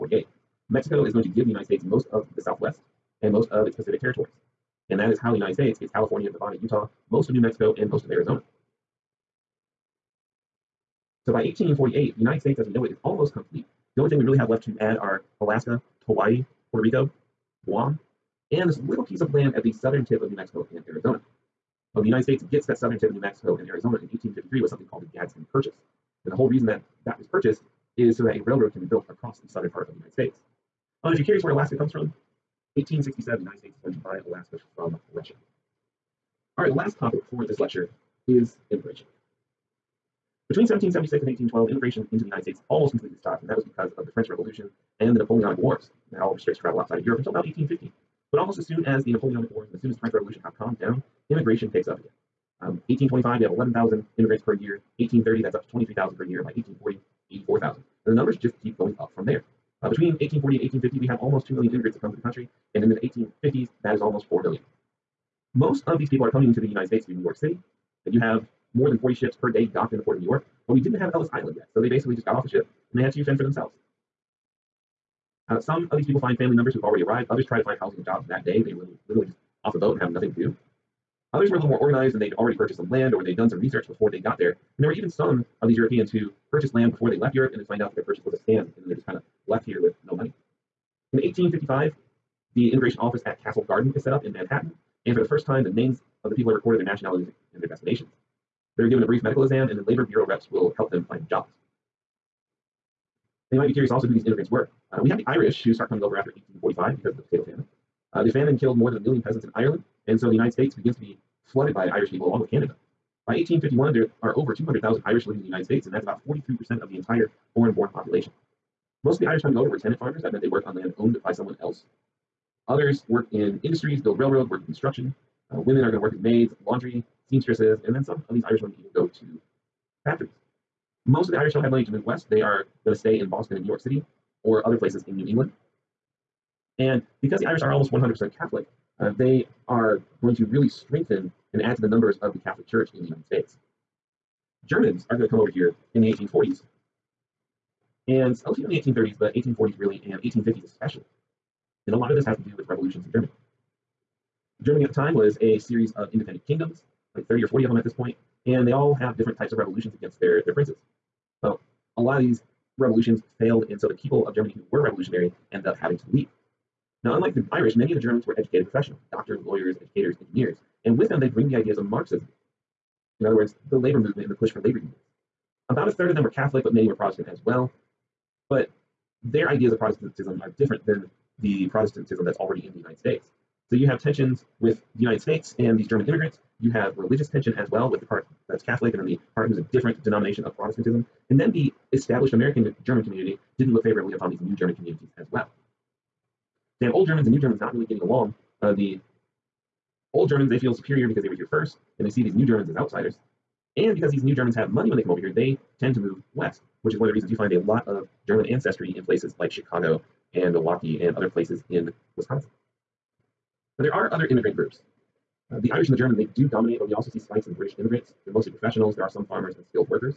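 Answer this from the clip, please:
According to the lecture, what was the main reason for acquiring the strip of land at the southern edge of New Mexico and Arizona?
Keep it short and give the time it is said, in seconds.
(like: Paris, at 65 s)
A railroad, at 28 s.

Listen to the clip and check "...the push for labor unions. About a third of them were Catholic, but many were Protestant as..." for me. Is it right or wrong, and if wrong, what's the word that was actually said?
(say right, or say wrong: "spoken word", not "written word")
right.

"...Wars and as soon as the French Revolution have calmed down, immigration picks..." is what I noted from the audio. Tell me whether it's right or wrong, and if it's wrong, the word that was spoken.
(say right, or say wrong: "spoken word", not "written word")
right.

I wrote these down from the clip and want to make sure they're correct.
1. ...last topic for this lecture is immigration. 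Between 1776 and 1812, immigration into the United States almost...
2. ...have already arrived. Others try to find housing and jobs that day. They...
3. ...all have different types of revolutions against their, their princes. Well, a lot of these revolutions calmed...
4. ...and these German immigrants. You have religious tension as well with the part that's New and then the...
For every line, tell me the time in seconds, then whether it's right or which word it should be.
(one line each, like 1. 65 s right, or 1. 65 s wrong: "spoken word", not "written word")
1. 36 s right
2. 76 s right
3. 158 s wrong: "failed", not "calmed"
4. 185 s wrong: "Catholic", not "New".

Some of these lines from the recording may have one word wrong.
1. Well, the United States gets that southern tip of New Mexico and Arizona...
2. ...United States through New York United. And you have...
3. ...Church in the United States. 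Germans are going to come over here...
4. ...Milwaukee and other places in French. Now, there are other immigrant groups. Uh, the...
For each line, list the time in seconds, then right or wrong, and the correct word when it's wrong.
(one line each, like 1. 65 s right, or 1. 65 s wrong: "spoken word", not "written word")
1. 21 s right
2. 66 s wrong: "City", not "United"
3. 142 s right
4. 210 s wrong: "Wisconsin", not "French".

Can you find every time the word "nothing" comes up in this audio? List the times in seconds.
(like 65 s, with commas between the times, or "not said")
80 s.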